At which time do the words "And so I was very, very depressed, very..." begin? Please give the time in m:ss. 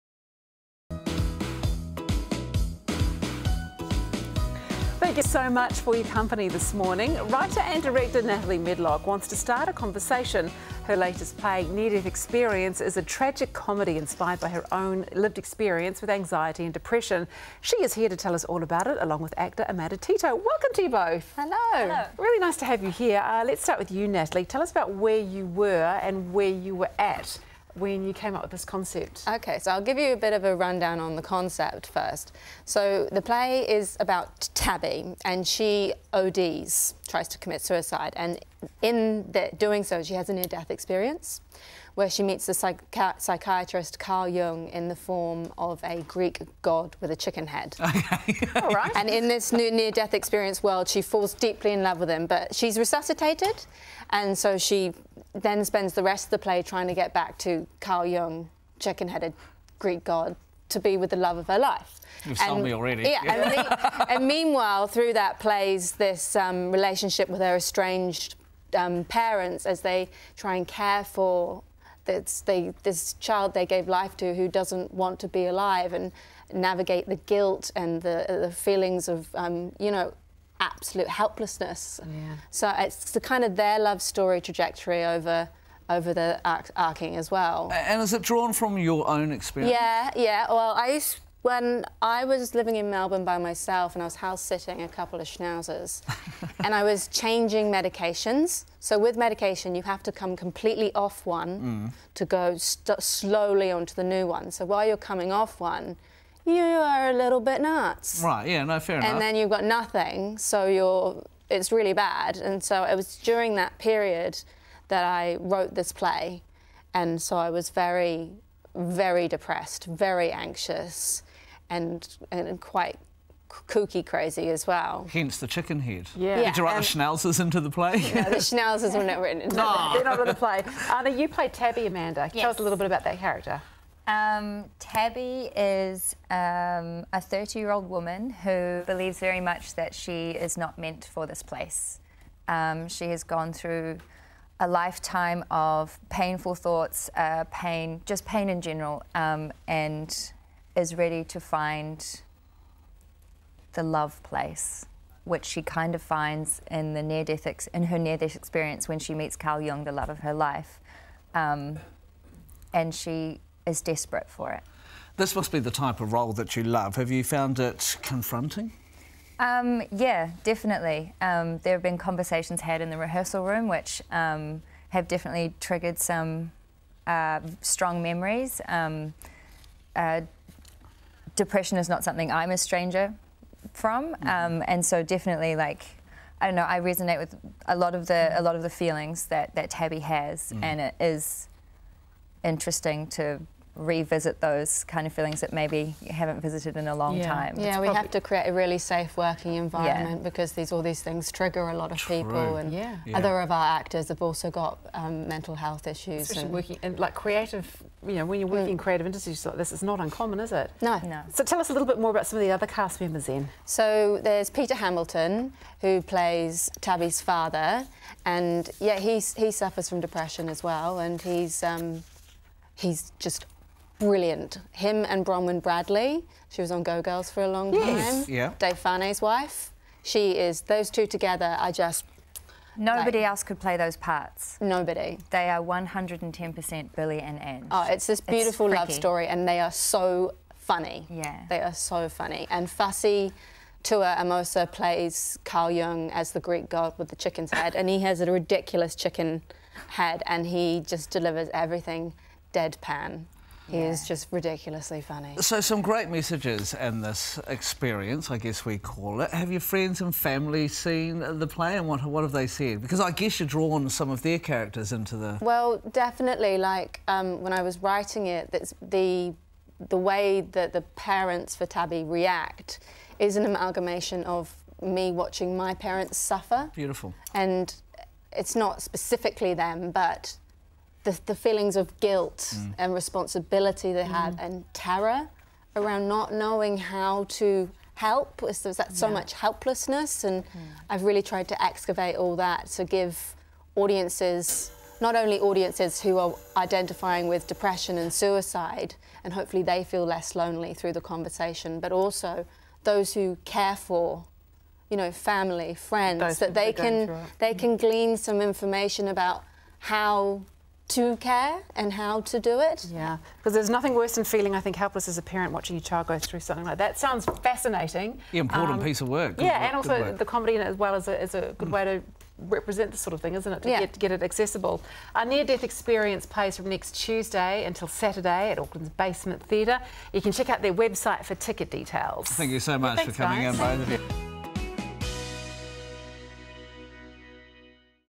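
1:56.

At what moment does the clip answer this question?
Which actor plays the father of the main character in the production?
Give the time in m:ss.
3:34.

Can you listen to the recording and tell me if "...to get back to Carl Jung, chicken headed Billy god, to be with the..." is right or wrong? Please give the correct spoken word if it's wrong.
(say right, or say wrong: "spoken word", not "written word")
wrong: "Greek", not "Billy".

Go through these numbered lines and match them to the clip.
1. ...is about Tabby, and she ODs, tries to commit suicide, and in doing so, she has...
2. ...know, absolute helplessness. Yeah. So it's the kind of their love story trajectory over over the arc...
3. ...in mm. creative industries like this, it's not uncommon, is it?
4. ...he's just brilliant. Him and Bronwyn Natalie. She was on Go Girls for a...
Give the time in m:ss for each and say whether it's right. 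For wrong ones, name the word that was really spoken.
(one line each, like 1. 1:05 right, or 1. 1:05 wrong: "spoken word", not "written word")
1. 0:33 right
2. 1:19 right
3. 3:28 right
4. 3:42 wrong: "Bradley", not "Natalie".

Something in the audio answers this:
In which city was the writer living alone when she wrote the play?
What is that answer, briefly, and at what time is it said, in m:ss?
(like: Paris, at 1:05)
Melbourne, at 1:32.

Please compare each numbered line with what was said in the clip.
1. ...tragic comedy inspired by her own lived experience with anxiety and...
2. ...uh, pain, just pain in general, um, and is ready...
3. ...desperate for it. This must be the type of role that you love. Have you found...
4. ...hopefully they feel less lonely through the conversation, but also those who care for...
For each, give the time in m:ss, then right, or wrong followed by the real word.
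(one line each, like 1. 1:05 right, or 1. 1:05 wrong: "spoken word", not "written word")
1. 0:13 right
2. 2:27 right
3. 2:43 right
4. 4:59 right.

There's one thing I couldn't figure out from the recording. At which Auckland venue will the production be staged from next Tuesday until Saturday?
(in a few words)
Basement Theatre.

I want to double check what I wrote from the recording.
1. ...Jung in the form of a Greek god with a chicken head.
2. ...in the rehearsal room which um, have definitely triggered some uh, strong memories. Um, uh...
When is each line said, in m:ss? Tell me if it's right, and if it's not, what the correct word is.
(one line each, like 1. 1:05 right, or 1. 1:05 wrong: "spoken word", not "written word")
1. 0:44 right
2. 2:52 right.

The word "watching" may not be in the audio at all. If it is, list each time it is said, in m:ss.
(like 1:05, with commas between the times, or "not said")
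4:35, 5:15.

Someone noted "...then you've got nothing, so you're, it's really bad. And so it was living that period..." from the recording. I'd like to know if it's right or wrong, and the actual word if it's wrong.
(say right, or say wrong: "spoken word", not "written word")
wrong: "during", not "living".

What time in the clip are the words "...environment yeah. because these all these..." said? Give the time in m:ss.
3:19.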